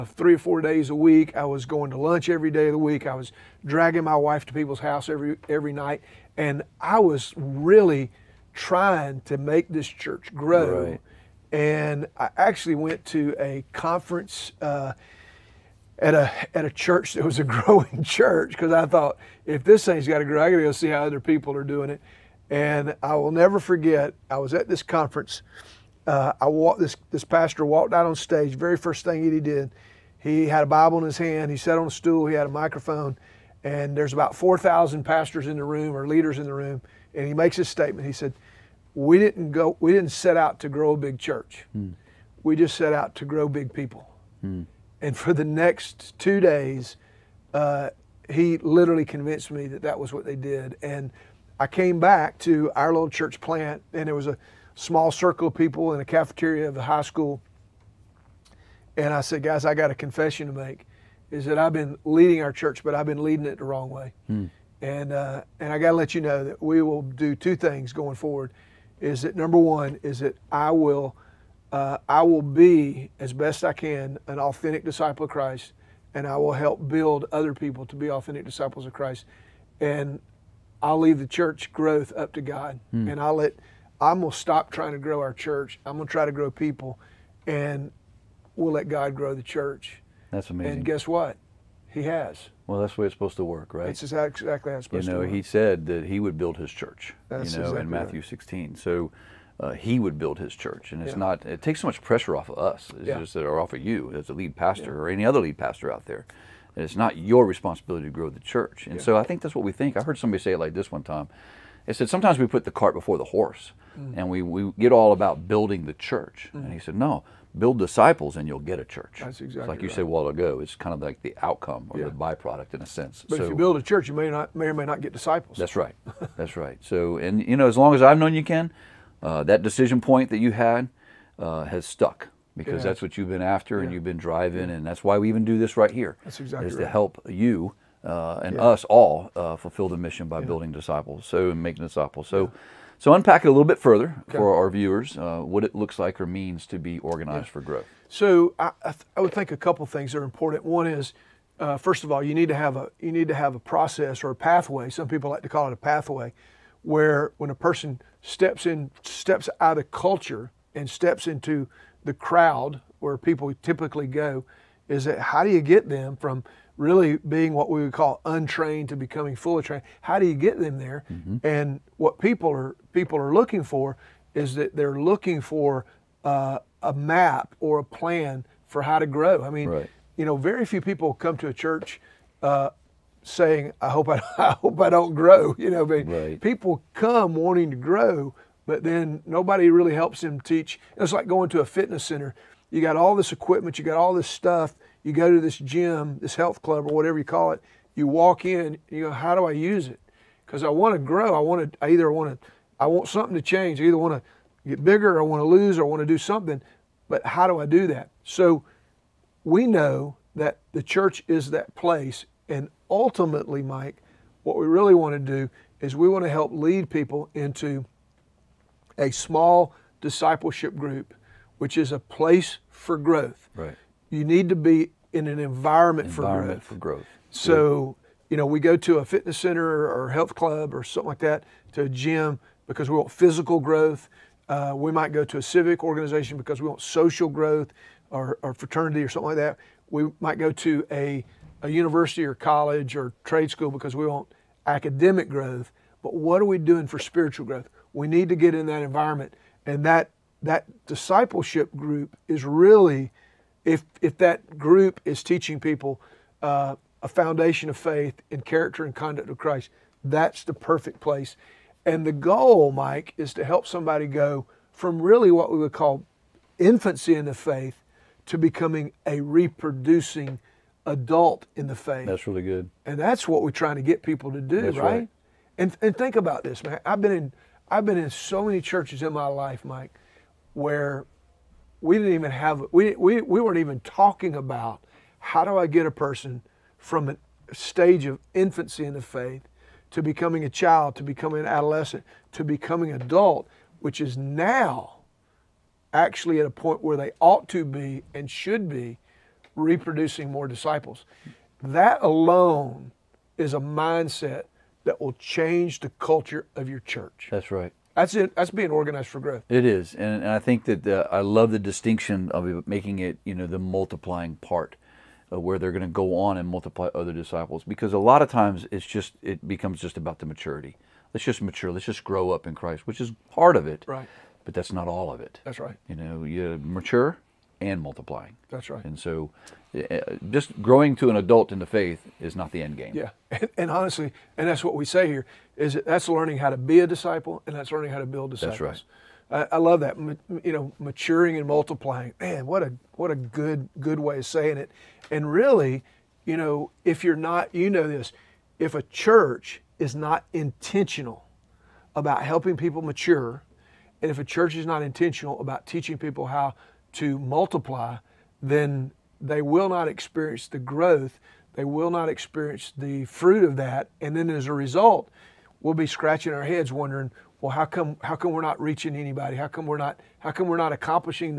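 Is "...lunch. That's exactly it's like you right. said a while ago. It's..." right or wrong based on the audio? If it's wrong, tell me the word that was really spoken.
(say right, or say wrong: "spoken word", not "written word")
wrong: "church", not "lunch".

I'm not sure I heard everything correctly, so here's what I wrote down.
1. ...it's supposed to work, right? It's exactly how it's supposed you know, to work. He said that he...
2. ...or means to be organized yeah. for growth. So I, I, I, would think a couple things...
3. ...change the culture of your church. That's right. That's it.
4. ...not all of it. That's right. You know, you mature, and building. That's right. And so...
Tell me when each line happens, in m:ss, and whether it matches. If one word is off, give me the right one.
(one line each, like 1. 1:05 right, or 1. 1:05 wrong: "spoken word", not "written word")
1. 1:33 right
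2. 2:26 right
3. 5:05 right
4. 5:24 wrong: "multiplying", not "building".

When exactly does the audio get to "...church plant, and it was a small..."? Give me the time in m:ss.
0:53.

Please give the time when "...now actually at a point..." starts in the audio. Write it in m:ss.
4:54.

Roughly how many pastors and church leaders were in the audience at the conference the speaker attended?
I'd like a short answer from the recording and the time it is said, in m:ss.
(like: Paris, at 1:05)
4000, at 0:34.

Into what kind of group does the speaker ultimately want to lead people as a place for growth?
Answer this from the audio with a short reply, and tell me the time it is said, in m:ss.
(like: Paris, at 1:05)
Small discipleship group, at 3:39.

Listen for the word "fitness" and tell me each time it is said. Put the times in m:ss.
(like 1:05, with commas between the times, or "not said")
3:11, 3:49.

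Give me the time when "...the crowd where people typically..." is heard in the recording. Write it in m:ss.
2:42.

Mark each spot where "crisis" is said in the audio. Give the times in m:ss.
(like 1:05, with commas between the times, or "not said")
not said.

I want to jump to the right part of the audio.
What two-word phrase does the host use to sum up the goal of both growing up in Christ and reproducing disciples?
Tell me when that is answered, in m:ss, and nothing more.
5:40.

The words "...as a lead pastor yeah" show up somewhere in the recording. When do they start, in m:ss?
1:44.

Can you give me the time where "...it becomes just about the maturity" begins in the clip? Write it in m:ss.
5:19.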